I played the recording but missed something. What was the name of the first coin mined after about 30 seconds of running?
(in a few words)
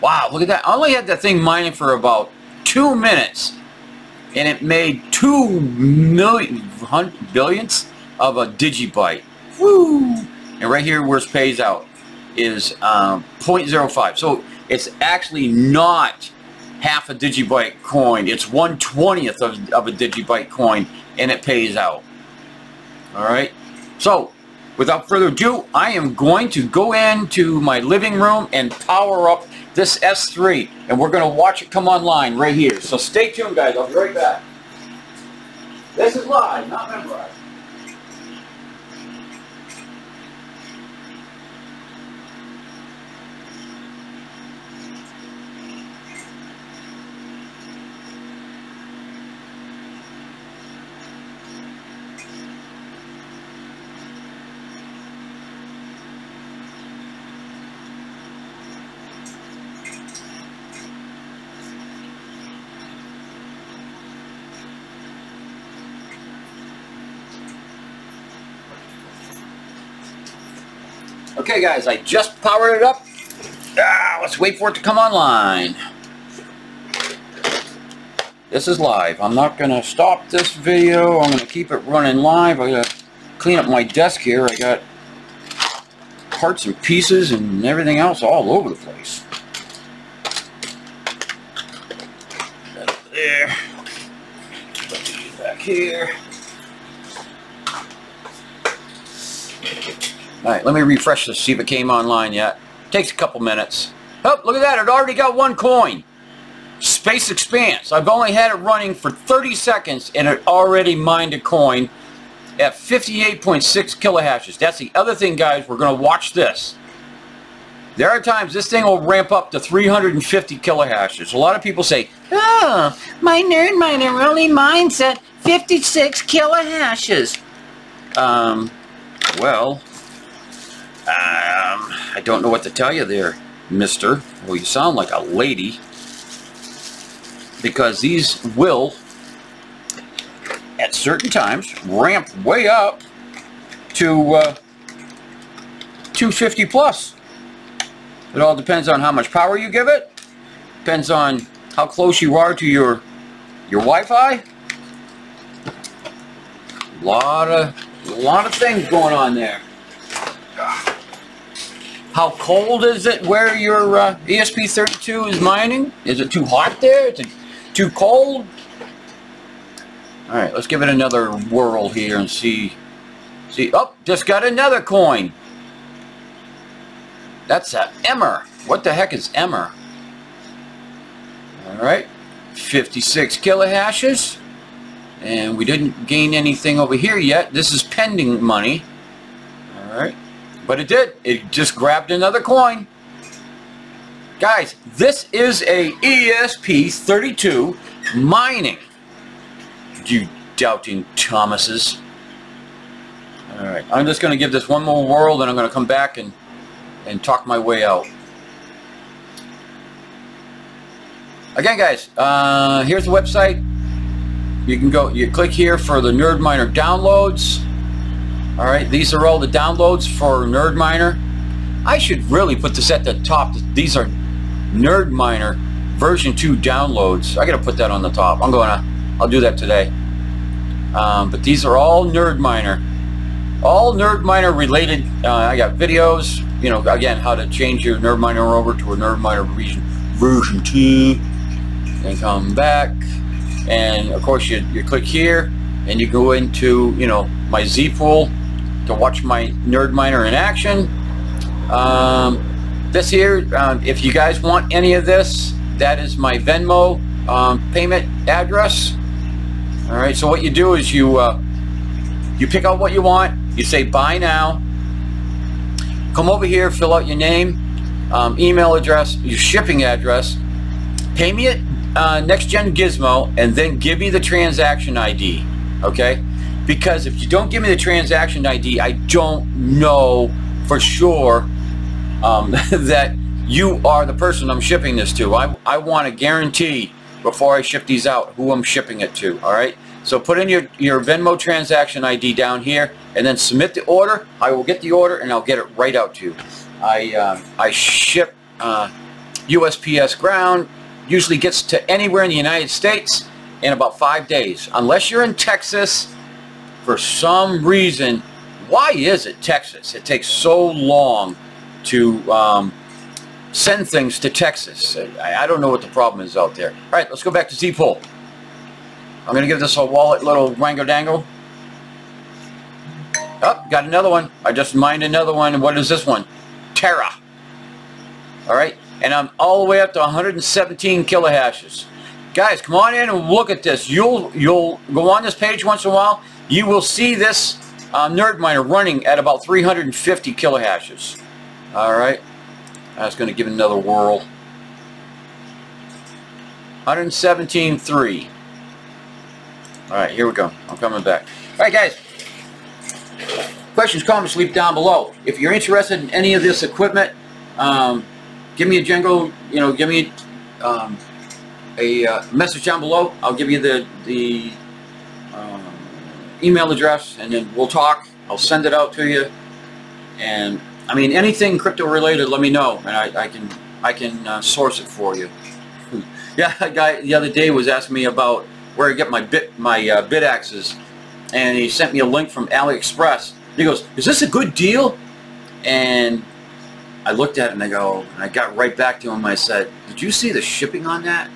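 Space Expanse.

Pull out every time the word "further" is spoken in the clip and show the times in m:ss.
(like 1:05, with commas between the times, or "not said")
0:25.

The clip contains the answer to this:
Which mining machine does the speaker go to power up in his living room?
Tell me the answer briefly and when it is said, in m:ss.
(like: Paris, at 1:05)
S3, at 0:29.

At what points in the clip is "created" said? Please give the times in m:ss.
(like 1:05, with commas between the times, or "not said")
not said.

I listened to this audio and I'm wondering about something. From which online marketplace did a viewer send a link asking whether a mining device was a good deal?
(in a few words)
AliExpress.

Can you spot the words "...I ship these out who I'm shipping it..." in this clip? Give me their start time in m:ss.
4:47.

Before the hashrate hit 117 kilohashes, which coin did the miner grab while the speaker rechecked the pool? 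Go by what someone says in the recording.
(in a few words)
Terra.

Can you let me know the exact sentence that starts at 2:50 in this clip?
Alright, let's give it another whirl here and see.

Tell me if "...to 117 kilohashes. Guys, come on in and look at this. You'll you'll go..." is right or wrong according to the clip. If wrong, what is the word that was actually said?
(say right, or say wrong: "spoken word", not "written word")
right.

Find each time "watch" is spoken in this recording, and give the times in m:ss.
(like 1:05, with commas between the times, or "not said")
0:31, 1:56, 4:08.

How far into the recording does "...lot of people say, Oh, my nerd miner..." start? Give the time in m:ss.
2:01.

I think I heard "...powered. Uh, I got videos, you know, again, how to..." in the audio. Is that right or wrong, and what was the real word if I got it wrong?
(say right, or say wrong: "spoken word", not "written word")
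wrong: "related", not "powered".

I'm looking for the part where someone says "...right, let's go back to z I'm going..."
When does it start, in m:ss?
5:16.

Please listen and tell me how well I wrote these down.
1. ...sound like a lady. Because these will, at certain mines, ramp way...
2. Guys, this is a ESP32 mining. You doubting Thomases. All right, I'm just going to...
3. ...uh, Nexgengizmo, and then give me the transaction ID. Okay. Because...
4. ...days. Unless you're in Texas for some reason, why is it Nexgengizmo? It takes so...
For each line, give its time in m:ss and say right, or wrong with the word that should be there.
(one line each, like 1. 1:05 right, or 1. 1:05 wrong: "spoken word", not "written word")
1. 2:14 wrong: "times", not "mines"
2. 3:14 right
3. 4:31 right
4. 5:04 wrong: "Texas", not "Nexgengizmo".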